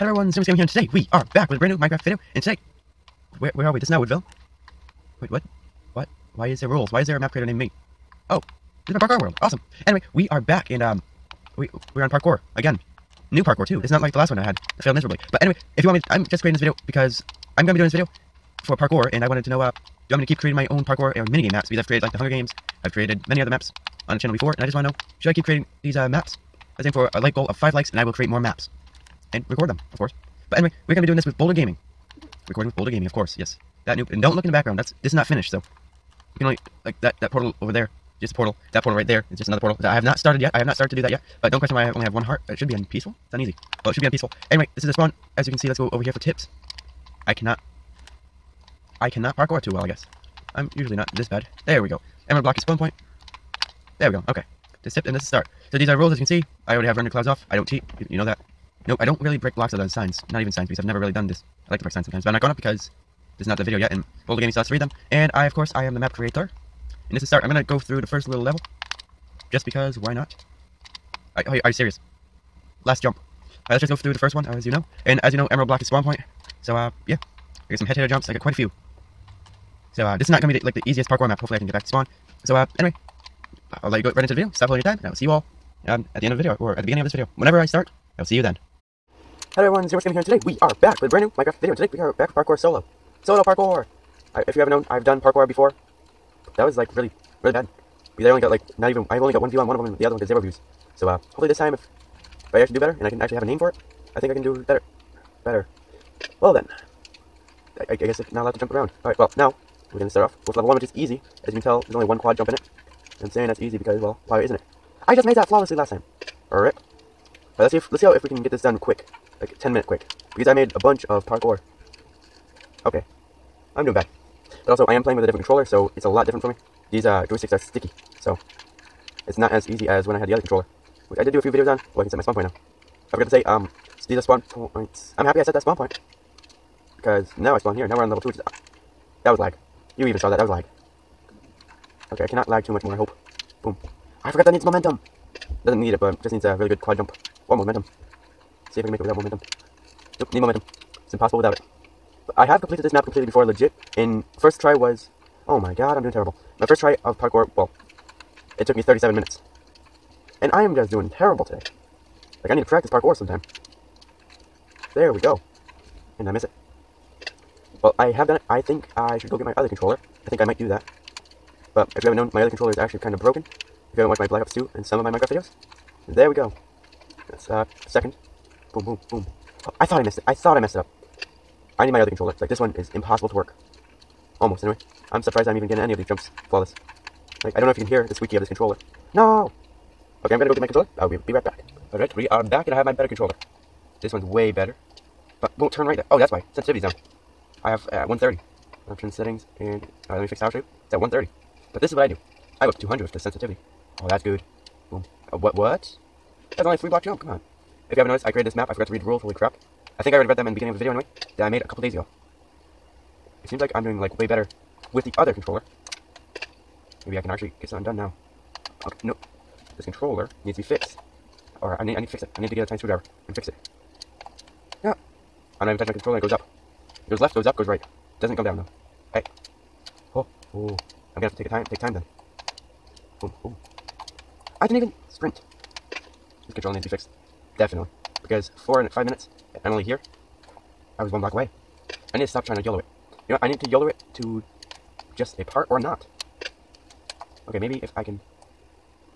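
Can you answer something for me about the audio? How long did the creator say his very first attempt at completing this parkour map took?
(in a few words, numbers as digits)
37 minutes.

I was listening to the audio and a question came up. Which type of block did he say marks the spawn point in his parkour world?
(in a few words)
Emerald block.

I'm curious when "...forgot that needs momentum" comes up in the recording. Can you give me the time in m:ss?
2:24.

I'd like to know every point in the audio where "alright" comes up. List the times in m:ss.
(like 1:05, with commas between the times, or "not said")
1:13, 1:49, 1:56, 3:11, 3:20, 3:41.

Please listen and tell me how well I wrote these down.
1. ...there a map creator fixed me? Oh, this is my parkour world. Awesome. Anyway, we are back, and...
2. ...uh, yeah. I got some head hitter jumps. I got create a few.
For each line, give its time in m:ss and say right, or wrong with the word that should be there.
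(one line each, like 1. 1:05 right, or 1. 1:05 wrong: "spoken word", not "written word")
1. 0:07 wrong: "named", not "fixed"
2. 1:16 wrong: "quite", not "create".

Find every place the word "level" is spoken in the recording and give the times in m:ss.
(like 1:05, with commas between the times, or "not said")
1:08, 1:50, 2:18.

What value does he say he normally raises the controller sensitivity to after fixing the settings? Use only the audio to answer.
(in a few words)
200.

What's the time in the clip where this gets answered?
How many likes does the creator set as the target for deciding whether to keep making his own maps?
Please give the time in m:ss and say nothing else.
0:27.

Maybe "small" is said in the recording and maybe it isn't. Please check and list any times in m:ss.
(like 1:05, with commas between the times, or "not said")
not said.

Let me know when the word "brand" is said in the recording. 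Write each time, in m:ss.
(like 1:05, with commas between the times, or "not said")
0:01, 1:31.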